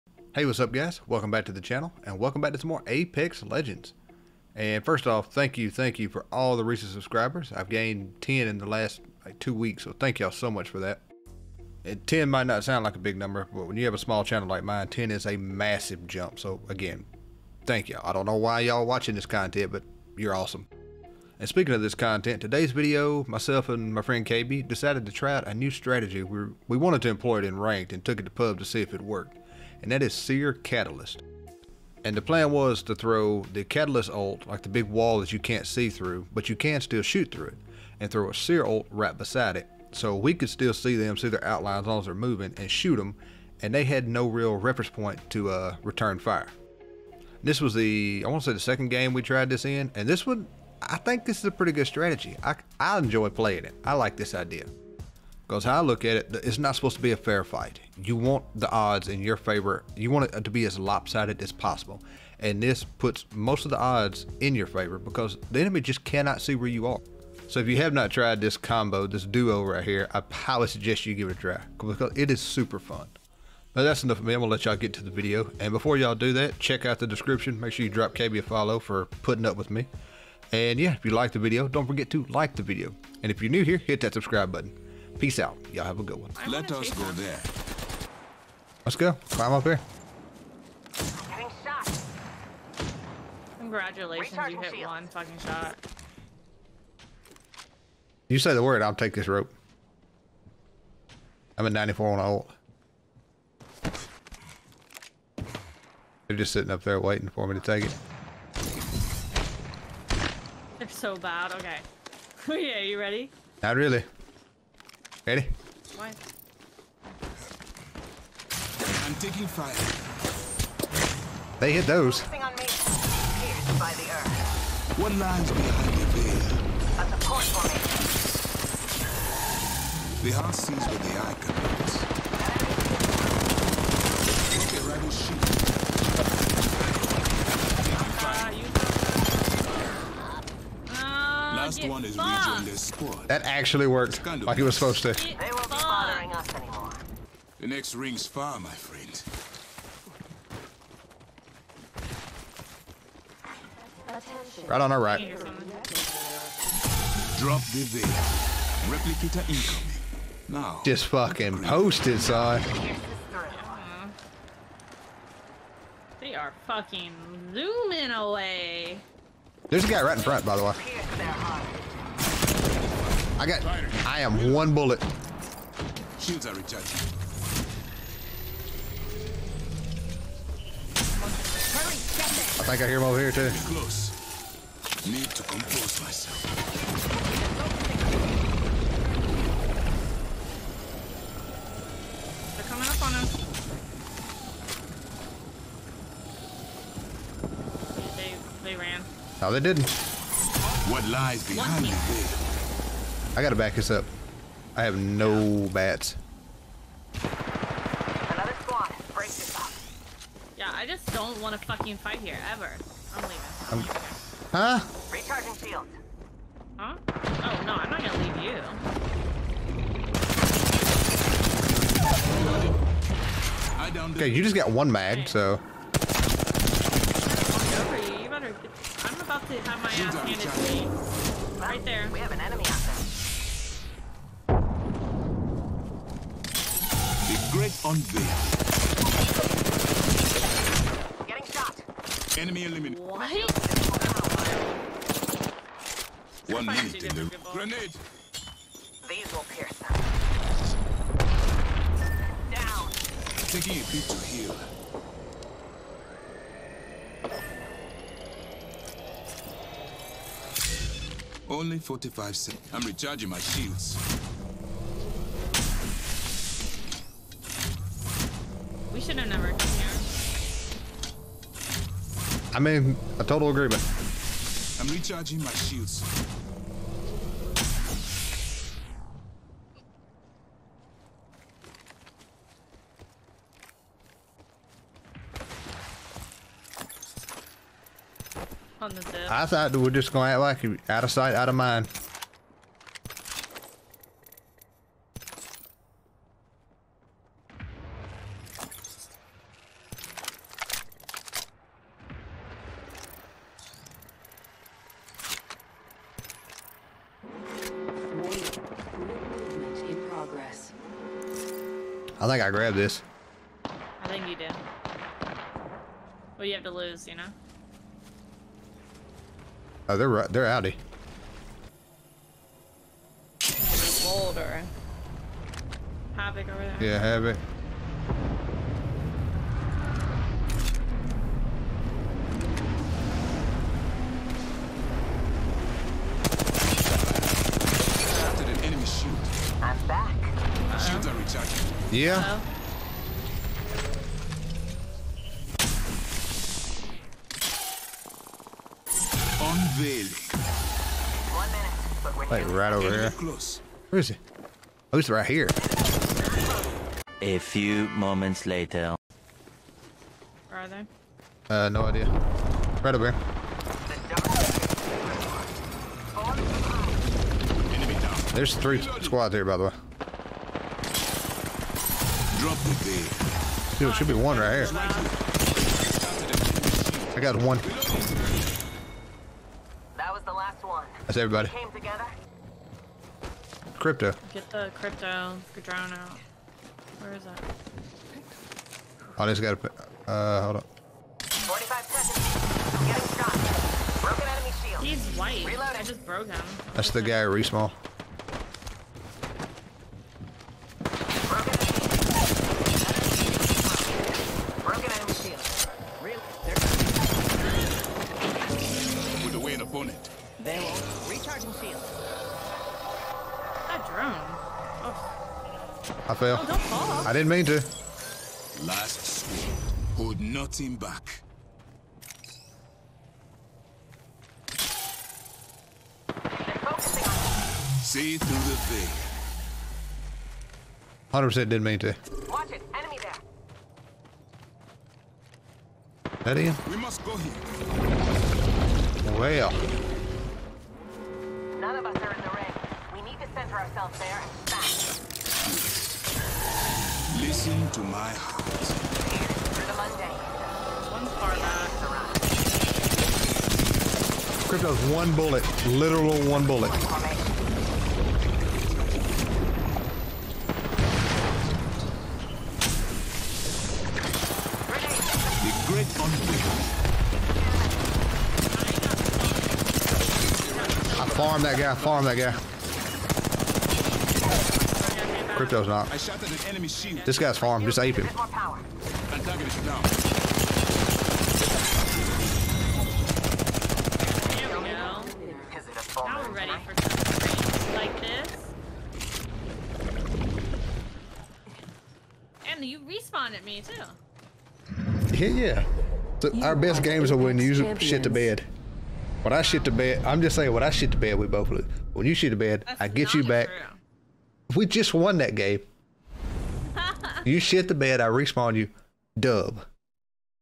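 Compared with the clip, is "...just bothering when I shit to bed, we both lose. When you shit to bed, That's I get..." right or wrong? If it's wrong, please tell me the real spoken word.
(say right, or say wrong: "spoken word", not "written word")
wrong: "saying", not "bothering".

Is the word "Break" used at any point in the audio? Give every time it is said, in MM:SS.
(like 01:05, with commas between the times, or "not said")
03:29.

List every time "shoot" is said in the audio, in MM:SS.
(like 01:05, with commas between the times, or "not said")
00:37, 00:42.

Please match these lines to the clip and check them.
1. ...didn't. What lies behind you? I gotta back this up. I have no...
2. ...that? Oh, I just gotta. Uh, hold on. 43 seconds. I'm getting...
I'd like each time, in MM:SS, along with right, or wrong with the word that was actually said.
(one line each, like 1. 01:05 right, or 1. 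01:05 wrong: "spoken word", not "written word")
1. 03:19 right
2. 06:27 wrong: "45", not "43".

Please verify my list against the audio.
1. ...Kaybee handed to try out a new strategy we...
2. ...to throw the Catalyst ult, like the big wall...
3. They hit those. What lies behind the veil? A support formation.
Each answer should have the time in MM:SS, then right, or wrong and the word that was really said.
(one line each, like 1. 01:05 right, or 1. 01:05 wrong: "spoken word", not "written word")
1. 00:24 wrong: "decided", not "handed"
2. 00:32 right
3. 02:01 right.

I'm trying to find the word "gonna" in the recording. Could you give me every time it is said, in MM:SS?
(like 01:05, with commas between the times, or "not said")
01:14, 03:38, 04:50.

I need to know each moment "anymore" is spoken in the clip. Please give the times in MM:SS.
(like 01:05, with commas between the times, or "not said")
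02:26.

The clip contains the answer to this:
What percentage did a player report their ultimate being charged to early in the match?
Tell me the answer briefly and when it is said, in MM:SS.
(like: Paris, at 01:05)
94, at 01:41.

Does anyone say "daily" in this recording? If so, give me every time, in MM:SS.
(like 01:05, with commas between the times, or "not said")
not said.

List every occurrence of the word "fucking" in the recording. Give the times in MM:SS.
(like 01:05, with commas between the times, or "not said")
01:35, 02:41, 02:46, 03:31.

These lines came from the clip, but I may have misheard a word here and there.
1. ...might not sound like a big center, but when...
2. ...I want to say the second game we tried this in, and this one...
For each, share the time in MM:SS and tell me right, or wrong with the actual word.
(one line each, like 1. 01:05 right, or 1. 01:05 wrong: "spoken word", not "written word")
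1. 00:12 wrong: "number", not "center"
2. 00:48 right.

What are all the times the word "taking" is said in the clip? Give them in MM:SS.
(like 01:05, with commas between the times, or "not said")
01:59, 04:13.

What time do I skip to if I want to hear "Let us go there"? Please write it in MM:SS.
01:26.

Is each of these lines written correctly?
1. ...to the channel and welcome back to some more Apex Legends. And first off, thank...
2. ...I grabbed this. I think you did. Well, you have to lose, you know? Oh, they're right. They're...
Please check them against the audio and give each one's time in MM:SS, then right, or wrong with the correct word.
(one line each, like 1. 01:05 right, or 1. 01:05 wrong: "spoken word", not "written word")
1. 00:01 right
2. 05:12 right.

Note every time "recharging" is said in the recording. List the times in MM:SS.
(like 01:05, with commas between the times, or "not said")
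02:56, 03:35, 04:22, 04:34.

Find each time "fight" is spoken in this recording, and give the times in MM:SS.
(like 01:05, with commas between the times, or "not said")
00:57, 03:31.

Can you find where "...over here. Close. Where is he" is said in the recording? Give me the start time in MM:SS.
05:52.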